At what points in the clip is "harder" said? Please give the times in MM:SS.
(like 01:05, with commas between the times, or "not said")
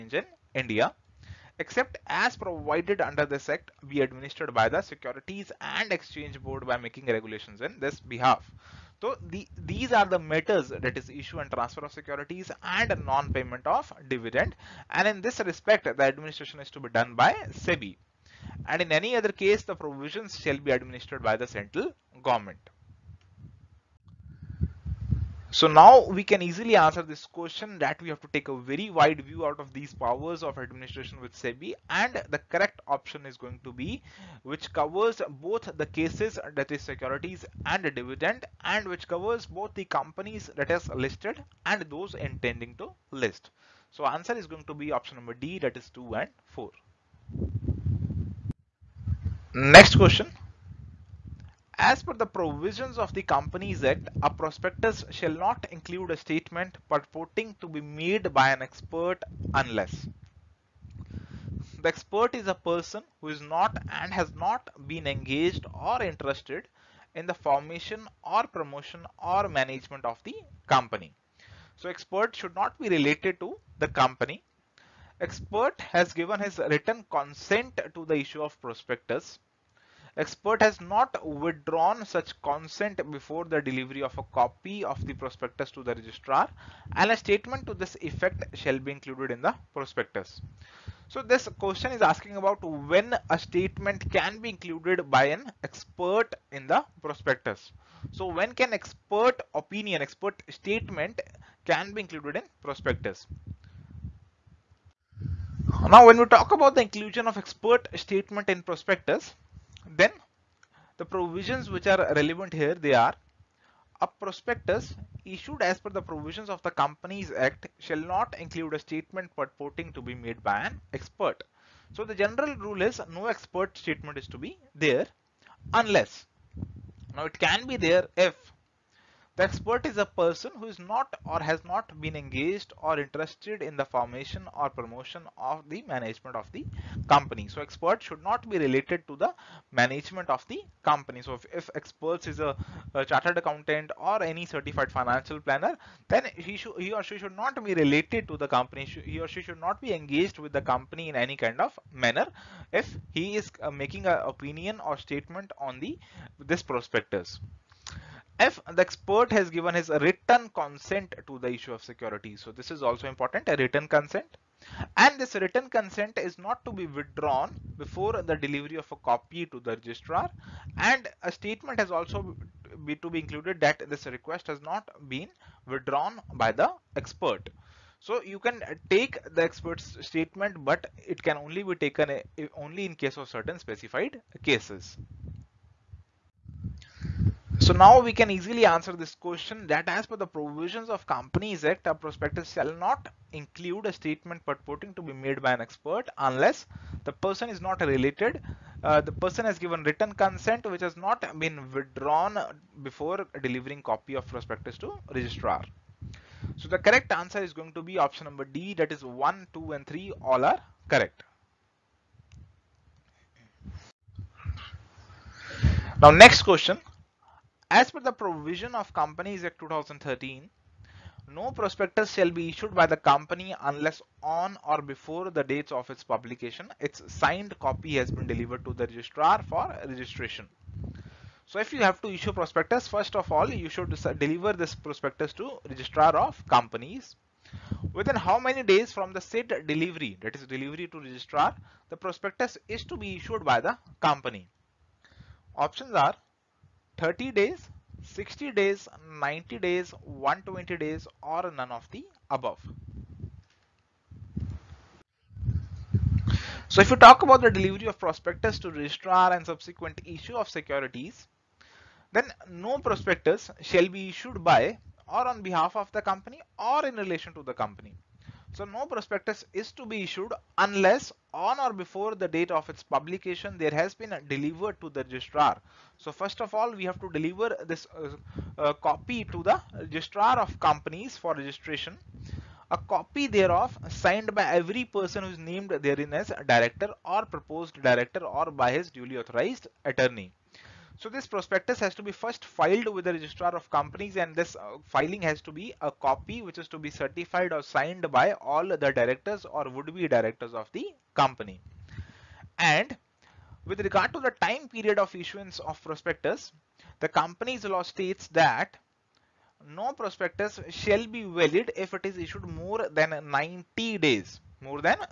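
not said.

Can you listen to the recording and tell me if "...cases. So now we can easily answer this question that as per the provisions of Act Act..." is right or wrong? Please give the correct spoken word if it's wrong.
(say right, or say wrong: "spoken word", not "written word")
wrong: "Companies", not "Act".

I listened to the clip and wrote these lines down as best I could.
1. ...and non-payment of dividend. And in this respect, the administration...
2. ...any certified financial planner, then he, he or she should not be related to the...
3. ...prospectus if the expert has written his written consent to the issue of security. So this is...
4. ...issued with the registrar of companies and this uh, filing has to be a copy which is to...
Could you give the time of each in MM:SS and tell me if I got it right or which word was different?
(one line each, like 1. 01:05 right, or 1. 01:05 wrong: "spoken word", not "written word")
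1. 00:12 right
2. 02:24 right
3. 02:36 wrong: "given", not "written"
4. 04:52 wrong: "filed", not "issued".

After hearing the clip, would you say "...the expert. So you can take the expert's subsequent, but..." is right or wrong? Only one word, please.
wrong.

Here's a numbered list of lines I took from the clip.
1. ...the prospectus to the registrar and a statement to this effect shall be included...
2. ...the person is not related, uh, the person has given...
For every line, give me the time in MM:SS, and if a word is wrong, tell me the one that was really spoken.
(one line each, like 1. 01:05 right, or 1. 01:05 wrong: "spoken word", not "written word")
1. 01:25 right
2. 03:17 right.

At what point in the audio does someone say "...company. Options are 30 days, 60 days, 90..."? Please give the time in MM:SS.
04:04.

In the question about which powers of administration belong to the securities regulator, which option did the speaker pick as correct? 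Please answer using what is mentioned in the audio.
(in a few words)
Option D (2 and 4).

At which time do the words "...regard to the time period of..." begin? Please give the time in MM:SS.
05:03.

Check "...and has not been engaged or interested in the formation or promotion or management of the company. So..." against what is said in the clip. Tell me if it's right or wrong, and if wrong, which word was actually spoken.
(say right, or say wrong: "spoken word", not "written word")
right.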